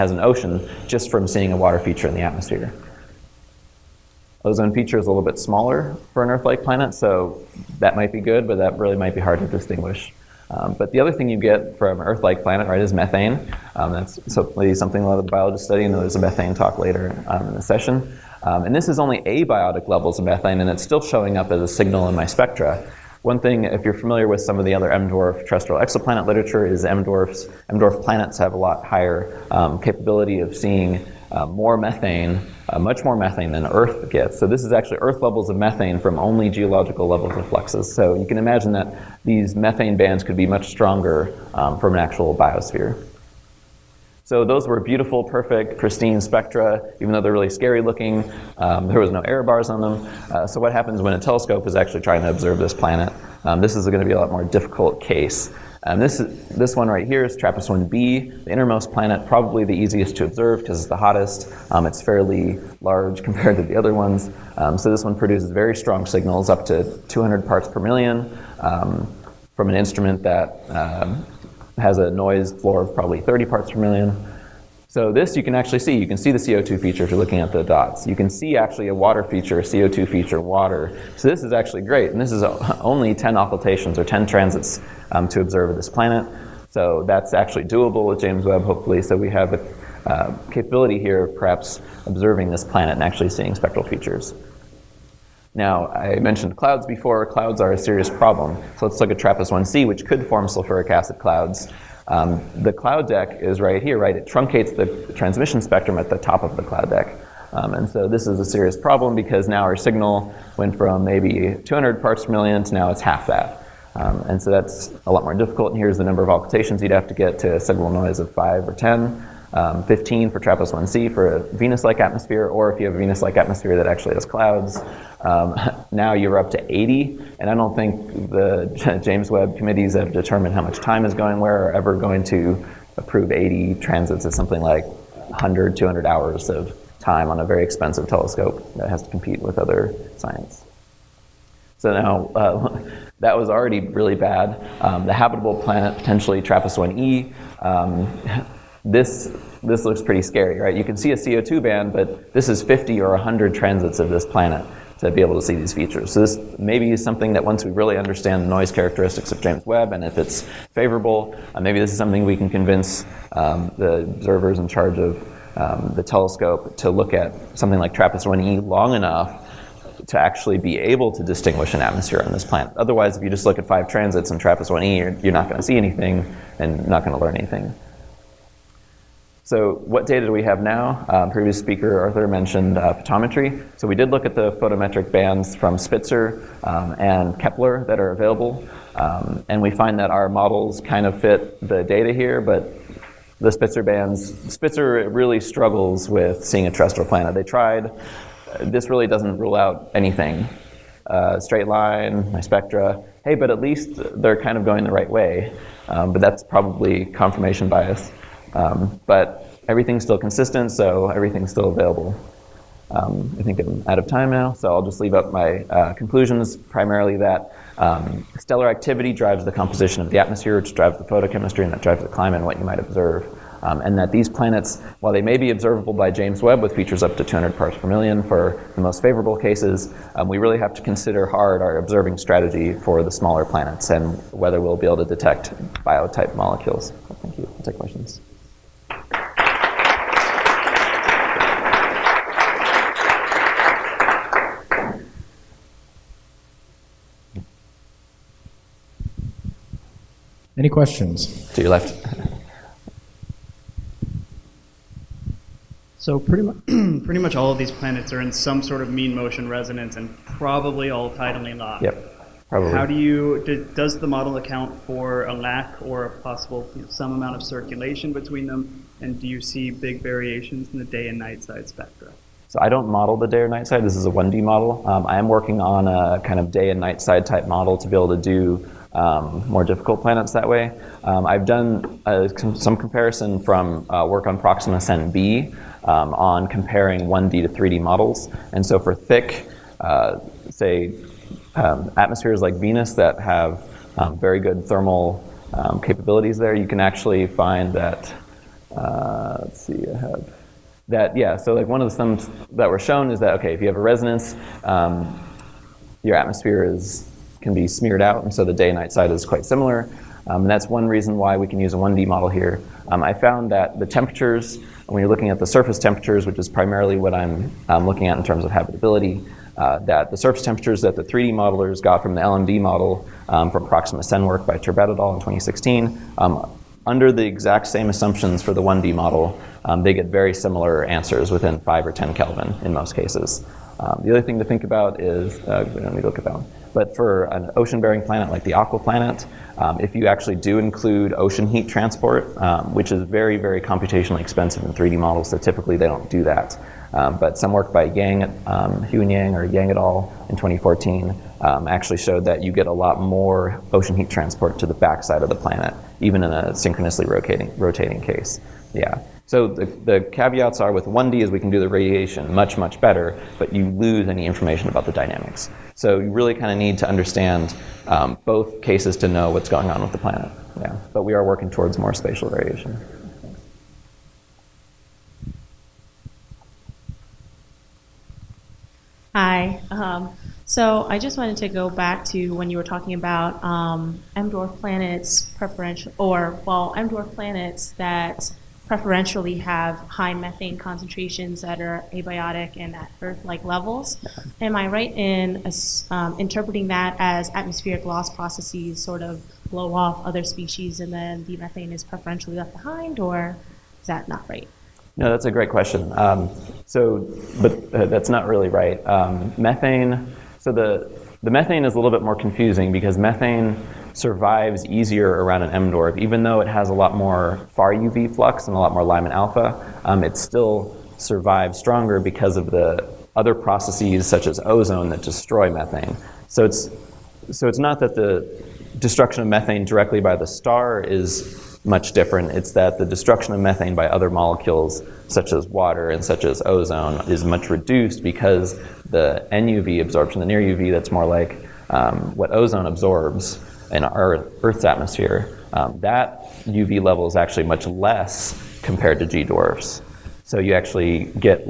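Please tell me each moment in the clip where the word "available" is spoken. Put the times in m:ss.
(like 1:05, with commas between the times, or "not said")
3:08, 3:31.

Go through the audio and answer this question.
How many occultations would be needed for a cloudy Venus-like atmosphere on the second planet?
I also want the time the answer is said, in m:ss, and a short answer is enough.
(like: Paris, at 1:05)
80, at 2:05.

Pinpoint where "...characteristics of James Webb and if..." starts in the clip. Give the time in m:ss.
2:38.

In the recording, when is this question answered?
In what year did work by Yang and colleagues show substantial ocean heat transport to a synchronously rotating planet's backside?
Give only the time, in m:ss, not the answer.
5:50.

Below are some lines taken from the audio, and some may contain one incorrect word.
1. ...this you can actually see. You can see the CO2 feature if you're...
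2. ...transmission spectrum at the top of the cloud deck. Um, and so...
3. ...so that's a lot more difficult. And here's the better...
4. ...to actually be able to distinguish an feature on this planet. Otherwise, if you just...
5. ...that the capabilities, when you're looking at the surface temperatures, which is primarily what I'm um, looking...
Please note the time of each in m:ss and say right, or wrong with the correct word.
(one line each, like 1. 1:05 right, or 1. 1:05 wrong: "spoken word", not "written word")
1. 1:15 right
2. 1:45 right
3. 1:54 wrong: "number", not "better"
4. 2:50 wrong: "atmosphere", not "feature"
5. 5:13 wrong: "temperatures", not "capabilities".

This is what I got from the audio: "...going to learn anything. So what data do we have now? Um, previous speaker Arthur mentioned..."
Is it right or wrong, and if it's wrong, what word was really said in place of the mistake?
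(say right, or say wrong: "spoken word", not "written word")
right.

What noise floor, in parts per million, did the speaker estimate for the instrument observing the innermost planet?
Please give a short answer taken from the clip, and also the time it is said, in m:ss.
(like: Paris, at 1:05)
30, at 1:12.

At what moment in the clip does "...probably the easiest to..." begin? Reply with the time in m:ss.
0:59.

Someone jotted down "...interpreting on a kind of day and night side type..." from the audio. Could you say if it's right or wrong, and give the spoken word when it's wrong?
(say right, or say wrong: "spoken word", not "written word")
wrong: "working", not "interpreting".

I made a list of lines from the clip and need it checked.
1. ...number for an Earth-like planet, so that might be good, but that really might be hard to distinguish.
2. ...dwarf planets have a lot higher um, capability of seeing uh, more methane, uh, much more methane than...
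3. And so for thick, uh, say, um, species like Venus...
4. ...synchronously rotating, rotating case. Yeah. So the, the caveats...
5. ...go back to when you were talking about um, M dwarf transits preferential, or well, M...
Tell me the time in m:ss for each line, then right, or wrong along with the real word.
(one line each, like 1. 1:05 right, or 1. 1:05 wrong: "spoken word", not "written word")
1. 0:05 wrong: "smaller", not "number"
2. 0:27 right
3. 4:48 wrong: "atmospheres", not "species"
4. 5:56 right
5. 6:21 wrong: "planets", not "transits".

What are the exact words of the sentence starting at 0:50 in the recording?
Uh, so what happens when a telescope is actually trying to observe this planet?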